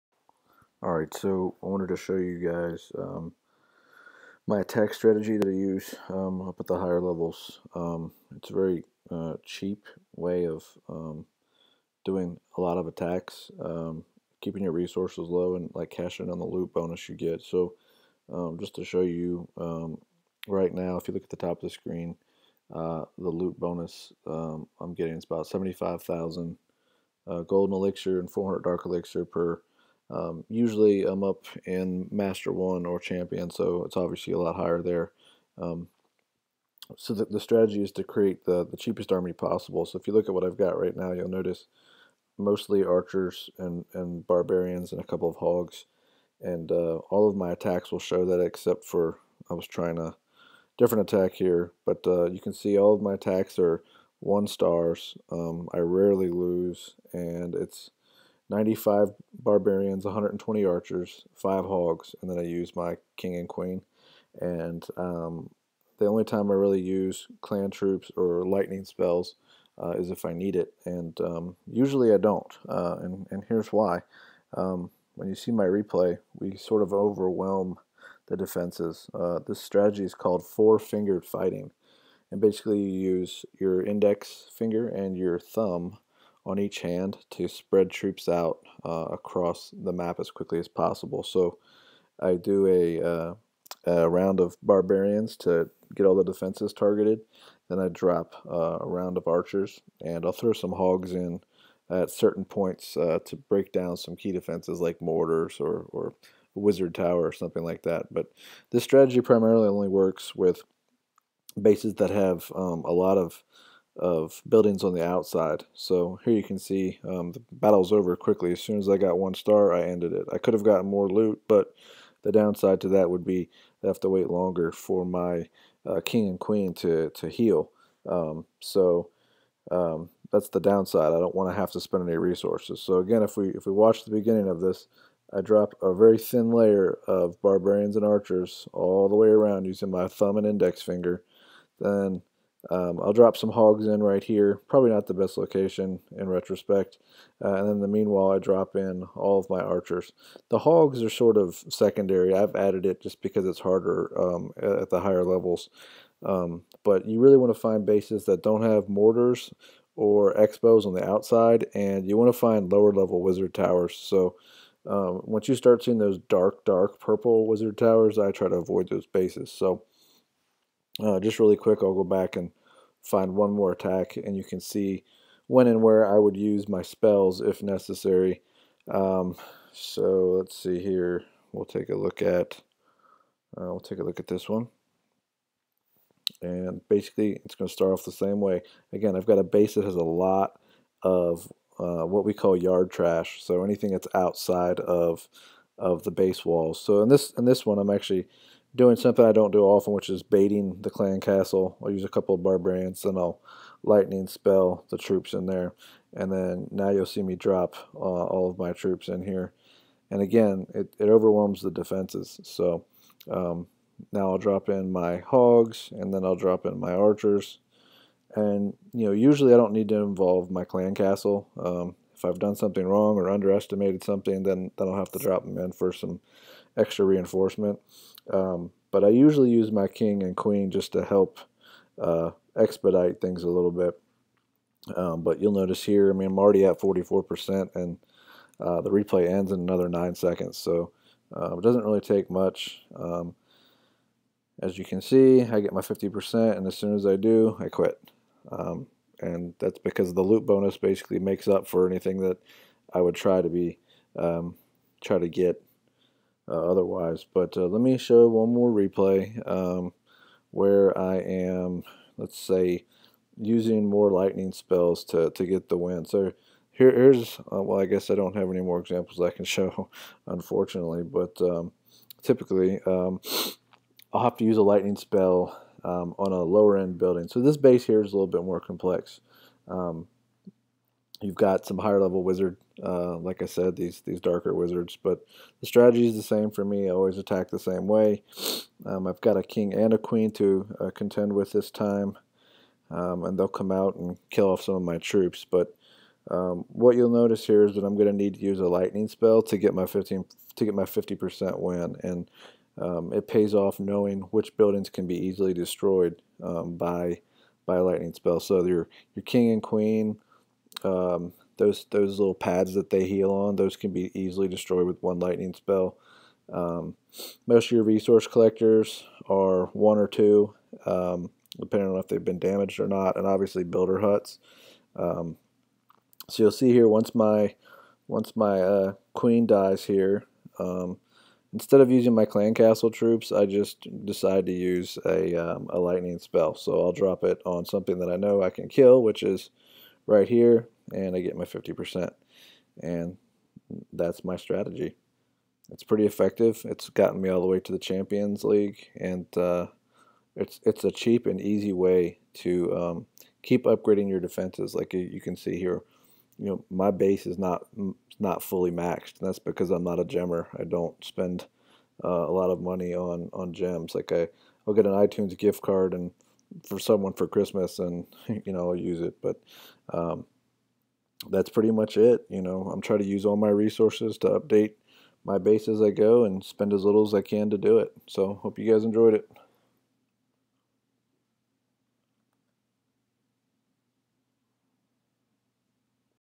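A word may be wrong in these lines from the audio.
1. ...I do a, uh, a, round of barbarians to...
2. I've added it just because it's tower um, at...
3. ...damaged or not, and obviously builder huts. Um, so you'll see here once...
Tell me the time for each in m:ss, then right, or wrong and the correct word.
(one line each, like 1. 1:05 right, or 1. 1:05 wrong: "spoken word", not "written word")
1. 1:32 right
2. 2:32 wrong: "harder", not "tower"
3. 5:22 right.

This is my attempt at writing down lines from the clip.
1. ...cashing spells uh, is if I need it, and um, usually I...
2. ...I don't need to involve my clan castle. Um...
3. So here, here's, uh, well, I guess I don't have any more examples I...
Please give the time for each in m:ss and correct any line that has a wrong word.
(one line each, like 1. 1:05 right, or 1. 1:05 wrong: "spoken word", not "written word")
1. 1:08 wrong: "lightning", not "cashing"
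2. 3:39 right
3. 4:26 right.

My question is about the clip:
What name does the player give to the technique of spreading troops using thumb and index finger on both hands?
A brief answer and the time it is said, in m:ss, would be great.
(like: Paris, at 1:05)
four-fingered fighting, at 1:20.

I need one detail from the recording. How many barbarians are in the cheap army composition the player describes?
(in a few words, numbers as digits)
95.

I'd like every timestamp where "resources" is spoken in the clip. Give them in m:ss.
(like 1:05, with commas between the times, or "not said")
0:14, 2:12, 5:17, 6:13.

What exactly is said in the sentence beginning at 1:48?
But this strategy primarily only works with bases that have um, a lot of of buildings on the outside.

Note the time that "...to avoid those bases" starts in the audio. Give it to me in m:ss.
2:48.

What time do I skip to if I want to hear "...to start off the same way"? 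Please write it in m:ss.
3:07.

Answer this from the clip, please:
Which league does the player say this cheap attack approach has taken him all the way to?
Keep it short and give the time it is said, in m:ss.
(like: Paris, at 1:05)
Champions League, at 5:47.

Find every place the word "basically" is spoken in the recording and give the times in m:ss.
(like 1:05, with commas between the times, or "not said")
1:22, 3:06, 4:10.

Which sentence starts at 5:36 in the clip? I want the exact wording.
So I'll drop it on something that I know I can kill, which is right here and I get my 50%.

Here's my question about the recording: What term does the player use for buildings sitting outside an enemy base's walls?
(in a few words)
yard trash.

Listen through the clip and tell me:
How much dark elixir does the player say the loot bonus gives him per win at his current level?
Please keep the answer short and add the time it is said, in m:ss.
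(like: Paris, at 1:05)
400, at 0:28.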